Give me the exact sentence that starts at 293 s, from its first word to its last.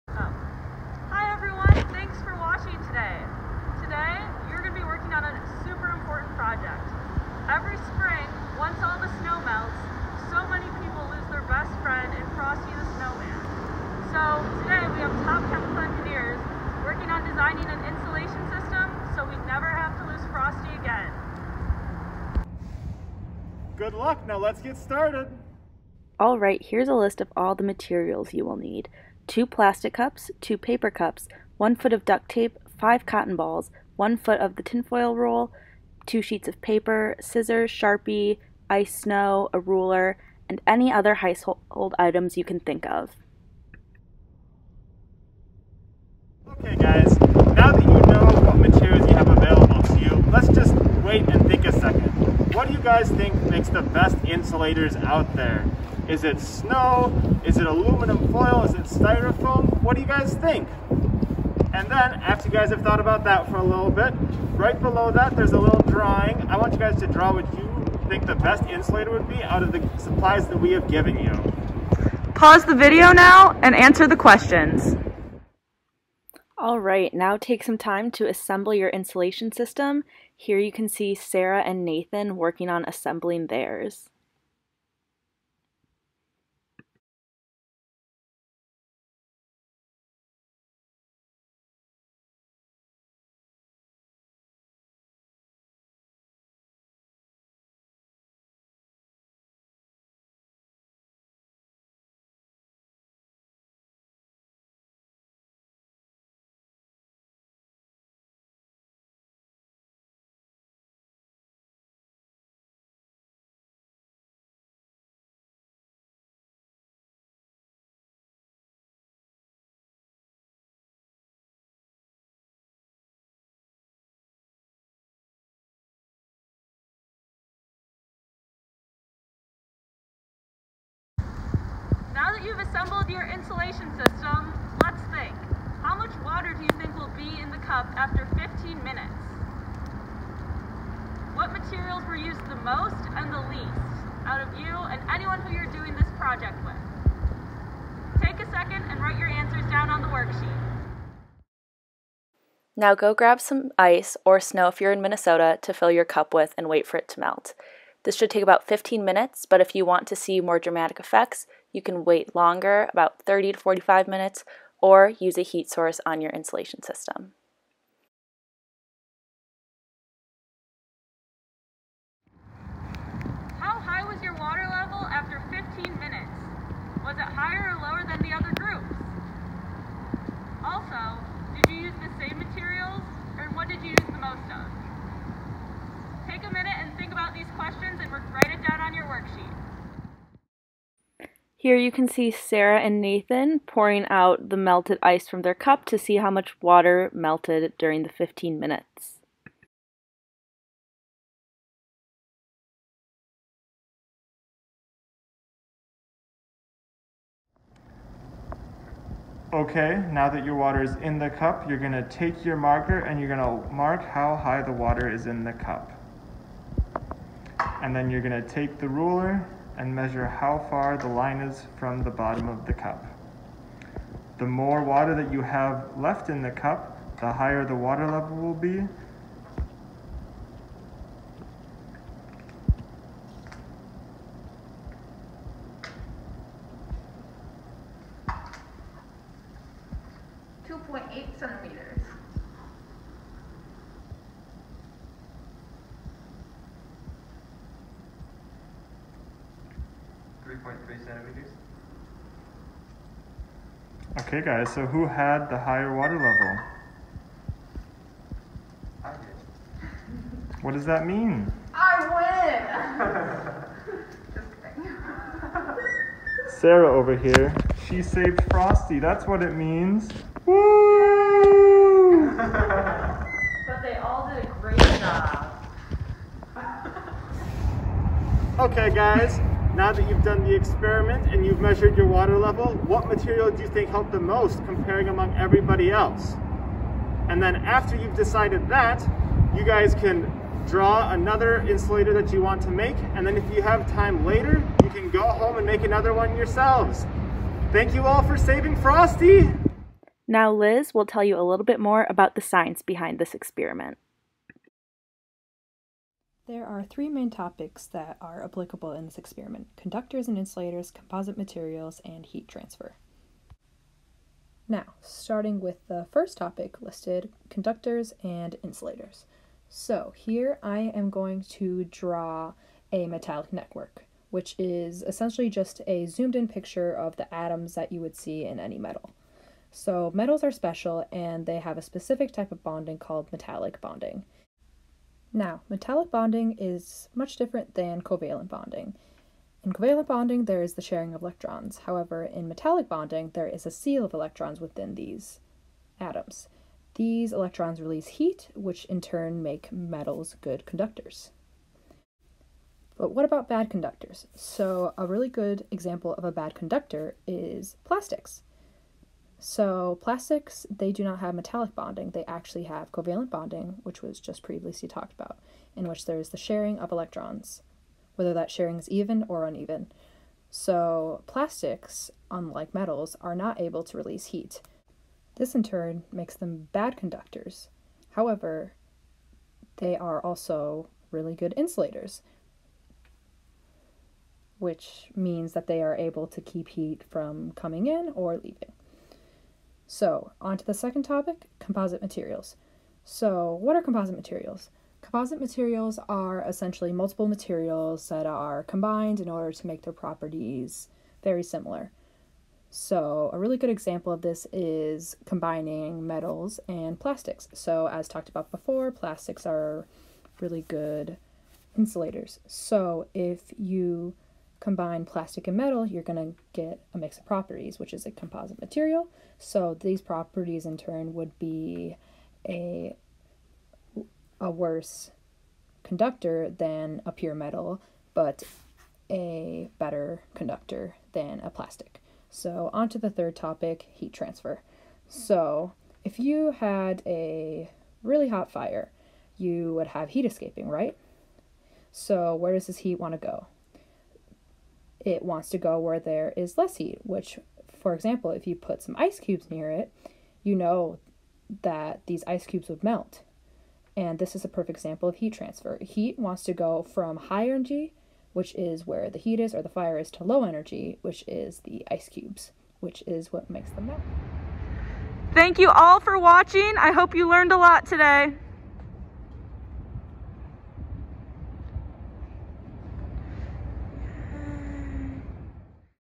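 And then if you have time later, you can go home and make another one yourselves.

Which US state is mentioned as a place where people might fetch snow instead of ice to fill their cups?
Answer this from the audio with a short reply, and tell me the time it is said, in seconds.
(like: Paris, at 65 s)
Minnesota, at 155 s.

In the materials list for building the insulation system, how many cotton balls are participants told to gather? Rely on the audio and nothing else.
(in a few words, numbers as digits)
5.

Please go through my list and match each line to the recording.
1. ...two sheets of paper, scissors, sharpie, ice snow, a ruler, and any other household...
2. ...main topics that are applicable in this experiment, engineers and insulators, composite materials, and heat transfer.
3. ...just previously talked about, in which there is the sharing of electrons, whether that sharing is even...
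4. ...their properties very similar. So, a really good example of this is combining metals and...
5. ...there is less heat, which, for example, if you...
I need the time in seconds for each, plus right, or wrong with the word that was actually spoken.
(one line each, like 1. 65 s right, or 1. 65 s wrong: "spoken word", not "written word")
1. 36 s right
2. 307 s wrong: "conductors", not "engineers"
3. 364 s right
4. 399 s right
5. 445 s right.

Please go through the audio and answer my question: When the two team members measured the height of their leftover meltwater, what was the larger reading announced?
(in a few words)
2.8 centimeters.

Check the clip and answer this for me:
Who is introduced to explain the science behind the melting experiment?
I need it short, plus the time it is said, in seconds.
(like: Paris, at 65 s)
Liz, at 300 s.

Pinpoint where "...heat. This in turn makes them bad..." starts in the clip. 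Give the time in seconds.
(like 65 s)
374 s.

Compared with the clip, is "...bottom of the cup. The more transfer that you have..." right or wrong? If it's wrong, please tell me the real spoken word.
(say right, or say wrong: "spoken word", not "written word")
wrong: "water", not "transfer".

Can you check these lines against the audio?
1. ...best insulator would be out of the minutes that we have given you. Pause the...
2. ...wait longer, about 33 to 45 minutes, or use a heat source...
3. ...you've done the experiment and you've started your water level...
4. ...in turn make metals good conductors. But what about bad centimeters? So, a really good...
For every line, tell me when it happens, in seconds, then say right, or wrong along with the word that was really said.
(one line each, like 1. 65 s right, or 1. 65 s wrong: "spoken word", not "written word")
1. 68 s wrong: "supplies", not "minutes"
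2. 162 s wrong: "30", not "33"
3. 280 s wrong: "measured", not "started"
4. 348 s wrong: "conductors", not "centimeters".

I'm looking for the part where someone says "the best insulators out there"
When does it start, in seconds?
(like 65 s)
53 s.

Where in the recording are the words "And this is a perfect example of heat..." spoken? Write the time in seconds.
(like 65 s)
453 s.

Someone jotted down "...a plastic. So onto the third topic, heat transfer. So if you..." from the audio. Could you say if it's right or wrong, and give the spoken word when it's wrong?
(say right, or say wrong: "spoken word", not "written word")
right.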